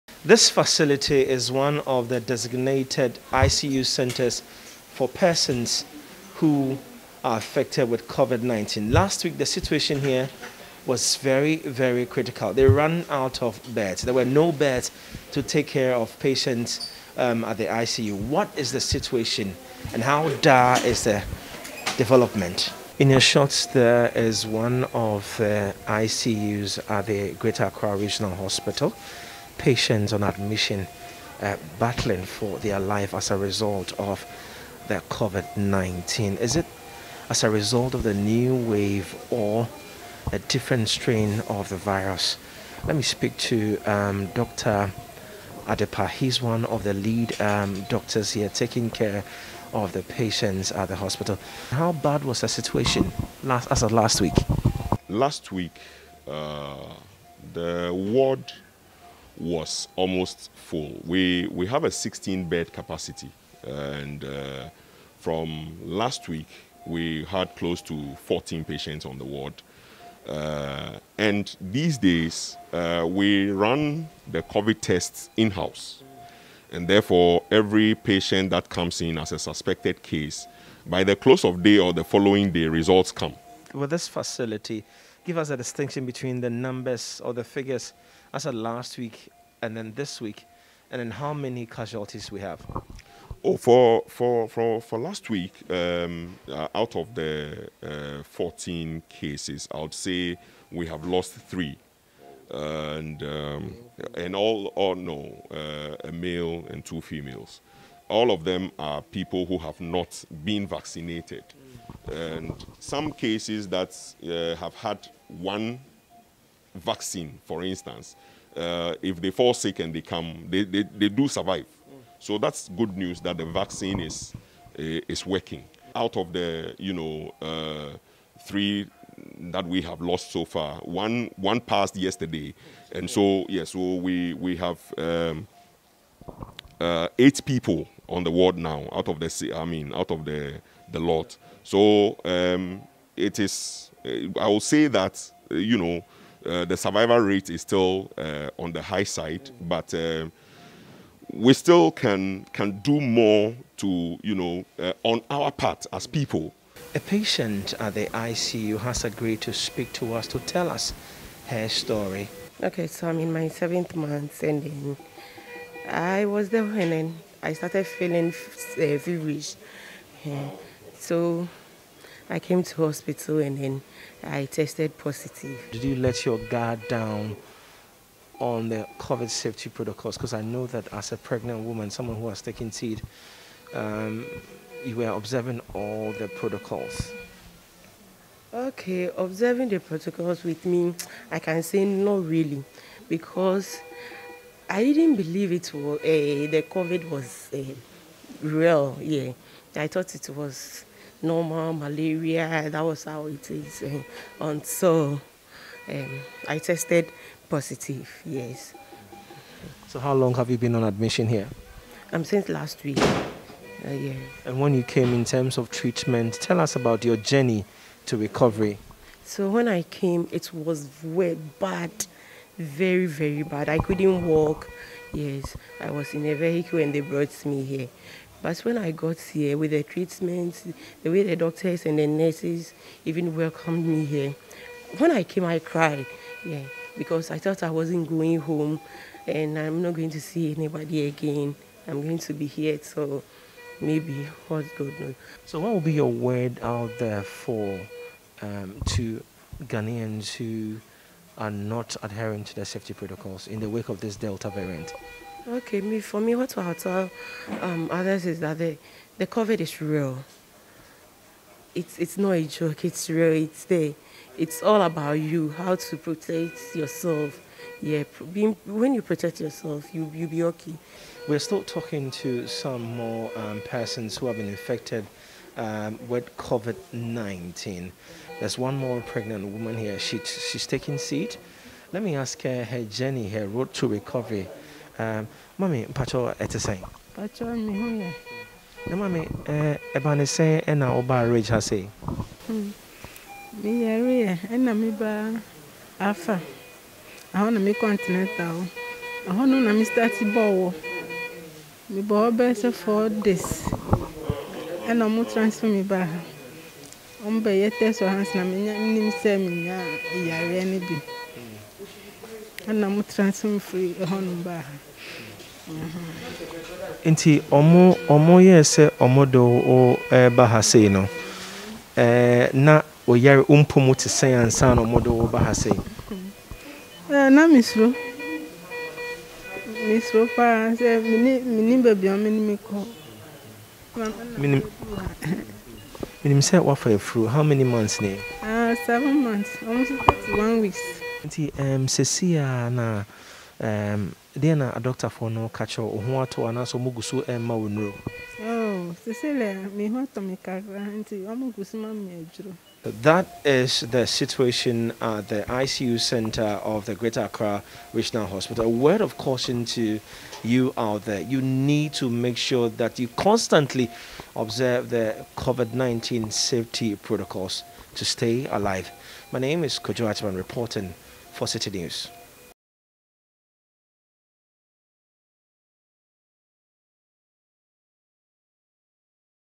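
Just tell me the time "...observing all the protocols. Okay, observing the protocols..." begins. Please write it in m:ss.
3:05.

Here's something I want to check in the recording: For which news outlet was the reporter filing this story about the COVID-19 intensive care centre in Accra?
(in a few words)
Citi News.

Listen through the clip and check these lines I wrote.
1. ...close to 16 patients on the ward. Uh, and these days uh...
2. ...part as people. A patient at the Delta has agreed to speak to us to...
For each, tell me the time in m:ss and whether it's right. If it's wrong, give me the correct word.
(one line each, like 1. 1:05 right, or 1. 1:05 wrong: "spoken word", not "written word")
1. 1:07 wrong: "14", not "16"
2. 2:35 wrong: "ICU", not "Delta".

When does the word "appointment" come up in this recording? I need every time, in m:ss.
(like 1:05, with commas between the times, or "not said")
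not said.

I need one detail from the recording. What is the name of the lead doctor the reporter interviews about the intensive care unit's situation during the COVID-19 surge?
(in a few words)
Dr. Adepa.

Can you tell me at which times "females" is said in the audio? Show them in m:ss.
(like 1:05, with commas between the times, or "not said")
1:47.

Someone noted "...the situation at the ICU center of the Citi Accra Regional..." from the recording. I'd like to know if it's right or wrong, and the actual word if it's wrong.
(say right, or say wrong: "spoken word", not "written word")
wrong: "Greater", not "Citi".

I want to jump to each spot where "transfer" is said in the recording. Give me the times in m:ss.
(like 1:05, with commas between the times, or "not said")
5:05, 5:13.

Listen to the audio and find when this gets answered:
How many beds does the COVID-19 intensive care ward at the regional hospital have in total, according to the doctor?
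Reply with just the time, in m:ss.
1:01.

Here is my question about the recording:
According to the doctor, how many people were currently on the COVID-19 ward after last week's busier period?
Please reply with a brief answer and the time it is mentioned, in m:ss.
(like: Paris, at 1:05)
8, at 2:17.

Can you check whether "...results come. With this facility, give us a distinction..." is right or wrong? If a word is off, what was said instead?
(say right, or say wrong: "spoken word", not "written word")
right.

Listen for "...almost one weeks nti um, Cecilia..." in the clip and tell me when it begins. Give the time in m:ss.
5:39.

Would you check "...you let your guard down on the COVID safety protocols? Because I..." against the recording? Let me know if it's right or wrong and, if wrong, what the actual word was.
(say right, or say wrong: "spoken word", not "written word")
right.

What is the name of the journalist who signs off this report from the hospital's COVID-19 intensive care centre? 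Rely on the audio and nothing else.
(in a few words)
Kojo Atman.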